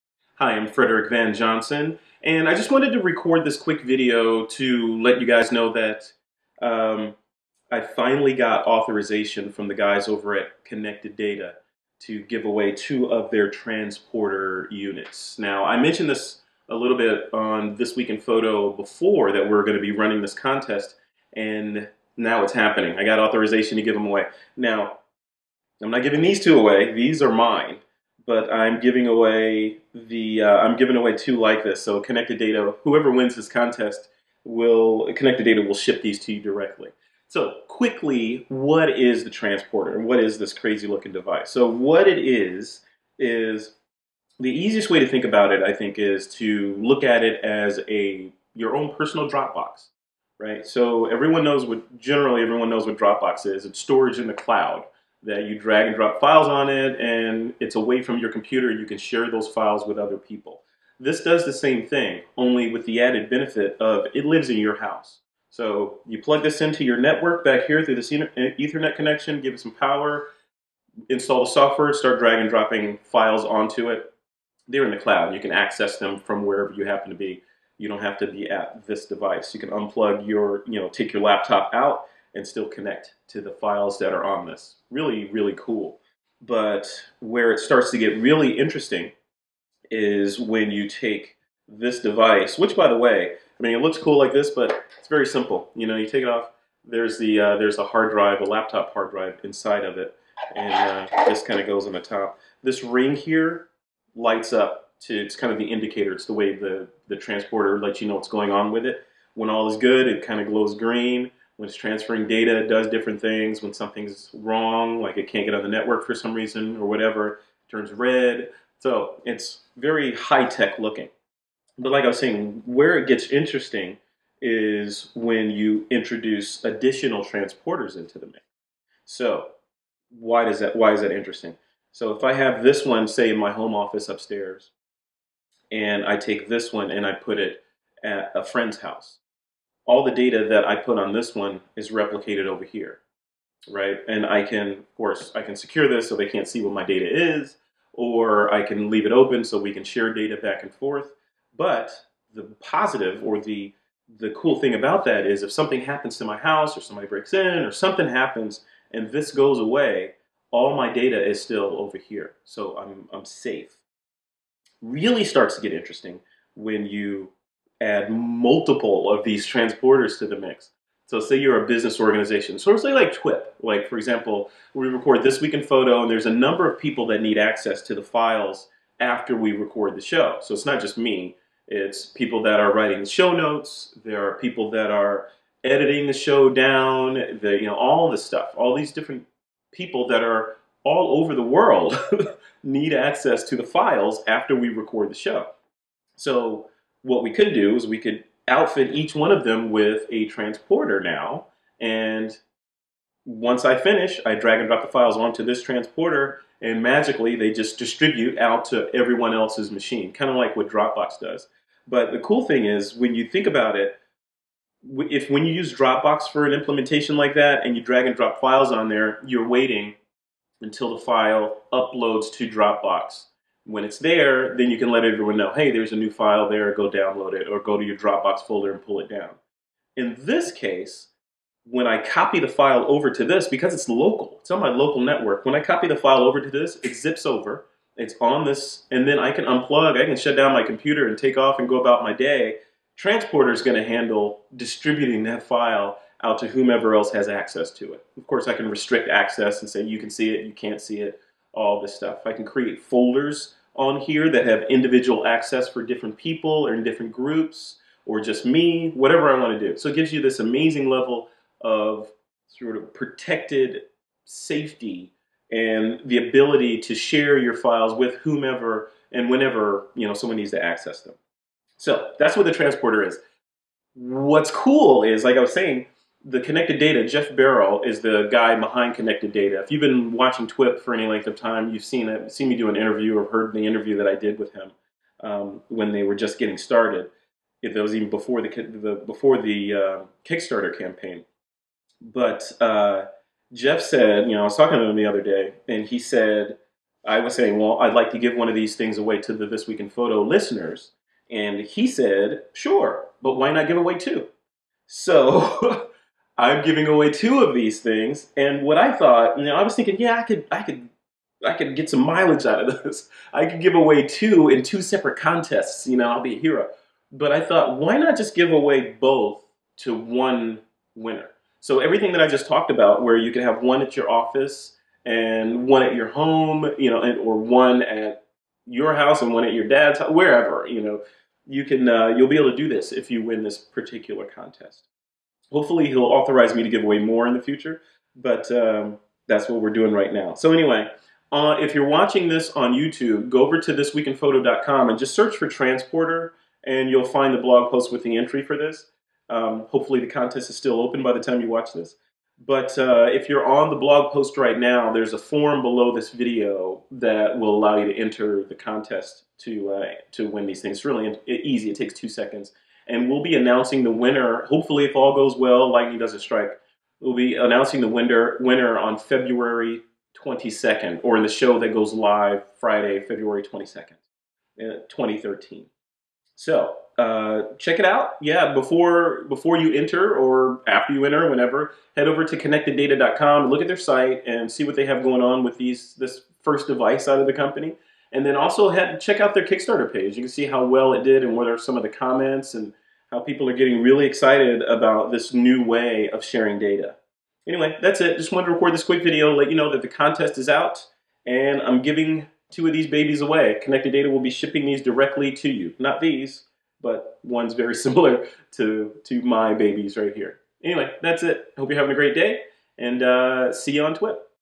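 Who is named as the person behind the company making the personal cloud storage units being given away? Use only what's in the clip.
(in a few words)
Geoff Barrall.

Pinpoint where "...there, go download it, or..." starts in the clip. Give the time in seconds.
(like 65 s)
226 s.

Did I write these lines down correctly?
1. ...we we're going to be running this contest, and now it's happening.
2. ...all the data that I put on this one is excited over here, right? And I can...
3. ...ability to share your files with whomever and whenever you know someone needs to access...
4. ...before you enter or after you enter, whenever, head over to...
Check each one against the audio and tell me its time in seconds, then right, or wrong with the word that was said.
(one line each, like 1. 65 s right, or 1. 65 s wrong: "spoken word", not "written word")
1. 19 s right
2. 139 s wrong: "replicated", not "excited"
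3. 266 s right
4. 379 s right.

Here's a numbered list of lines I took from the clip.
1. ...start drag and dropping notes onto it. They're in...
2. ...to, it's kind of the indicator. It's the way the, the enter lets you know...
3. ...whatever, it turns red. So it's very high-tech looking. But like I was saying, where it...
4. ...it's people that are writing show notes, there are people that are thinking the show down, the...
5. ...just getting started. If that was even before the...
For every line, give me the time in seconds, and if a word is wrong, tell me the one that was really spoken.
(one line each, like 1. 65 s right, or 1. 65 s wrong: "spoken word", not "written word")
1. 71 s wrong: "files", not "notes"
2. 105 s wrong: "transporter", not "enter"
3. 116 s right
4. 181 s wrong: "editing", not "thinking"
5. 286 s right.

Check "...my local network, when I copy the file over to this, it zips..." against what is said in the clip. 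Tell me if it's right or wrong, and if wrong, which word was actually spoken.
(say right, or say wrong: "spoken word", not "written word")
right.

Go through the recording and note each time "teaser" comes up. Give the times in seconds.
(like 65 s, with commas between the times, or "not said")
not said.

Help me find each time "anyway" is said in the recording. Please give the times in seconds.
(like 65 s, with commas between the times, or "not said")
340 s, 397 s, 410 s.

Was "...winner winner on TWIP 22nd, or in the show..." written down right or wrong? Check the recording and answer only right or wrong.
wrong.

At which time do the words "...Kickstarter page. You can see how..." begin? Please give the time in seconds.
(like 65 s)
389 s.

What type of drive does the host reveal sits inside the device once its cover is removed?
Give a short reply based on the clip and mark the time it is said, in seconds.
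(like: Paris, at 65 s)
laptop hard drive, at 98 s.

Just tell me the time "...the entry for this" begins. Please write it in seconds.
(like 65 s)
348 s.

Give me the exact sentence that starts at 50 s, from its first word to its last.
So everyone knows what generally everyone knows what Dropbox is.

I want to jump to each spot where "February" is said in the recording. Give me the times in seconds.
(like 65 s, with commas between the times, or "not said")
368 s, 372 s.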